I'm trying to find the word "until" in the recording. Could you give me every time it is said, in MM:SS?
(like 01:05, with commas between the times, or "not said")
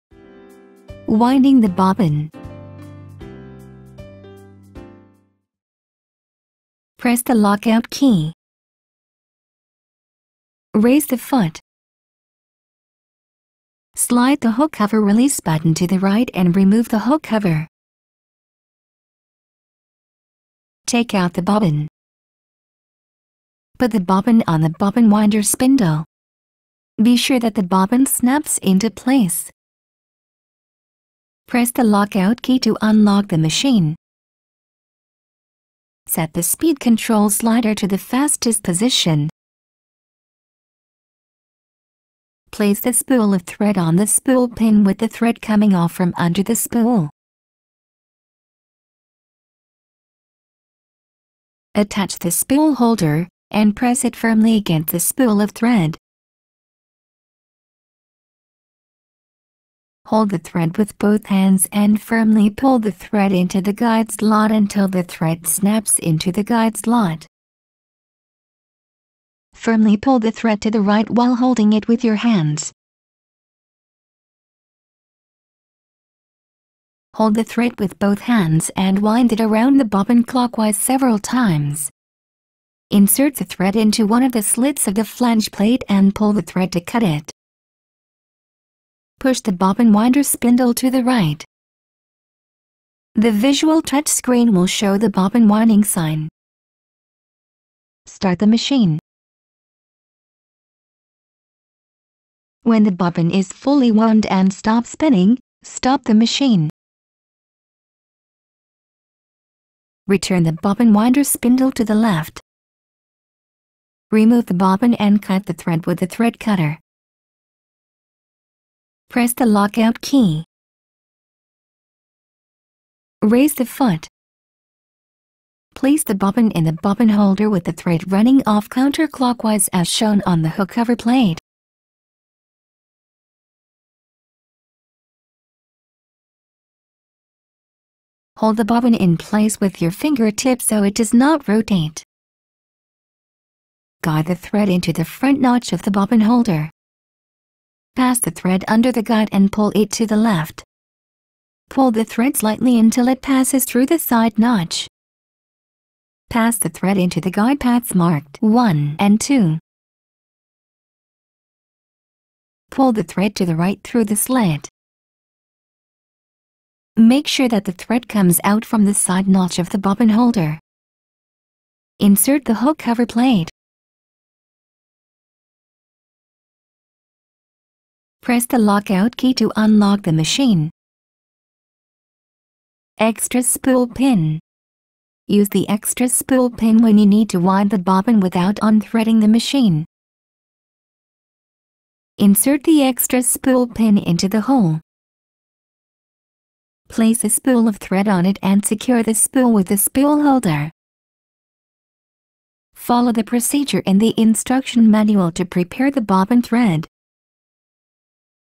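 01:04, 02:32.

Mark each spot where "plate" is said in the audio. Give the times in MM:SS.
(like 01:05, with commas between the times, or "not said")
01:25, 02:10, 02:53.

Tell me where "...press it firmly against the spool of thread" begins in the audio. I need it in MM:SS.
00:53.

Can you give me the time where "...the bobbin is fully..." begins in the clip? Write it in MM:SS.
01:42.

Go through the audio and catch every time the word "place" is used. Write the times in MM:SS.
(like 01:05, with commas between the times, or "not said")
00:28, 00:42, 02:05, 02:19, 03:16.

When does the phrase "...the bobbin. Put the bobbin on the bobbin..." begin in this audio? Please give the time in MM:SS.
00:21.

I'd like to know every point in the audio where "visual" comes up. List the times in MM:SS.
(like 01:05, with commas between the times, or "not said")
01:33.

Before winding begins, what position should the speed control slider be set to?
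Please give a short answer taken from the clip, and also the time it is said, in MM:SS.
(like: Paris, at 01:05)
the fastest position, at 00:37.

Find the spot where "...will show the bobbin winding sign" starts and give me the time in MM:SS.
01:34.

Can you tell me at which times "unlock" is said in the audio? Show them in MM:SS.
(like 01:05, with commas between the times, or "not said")
00:32, 02:59.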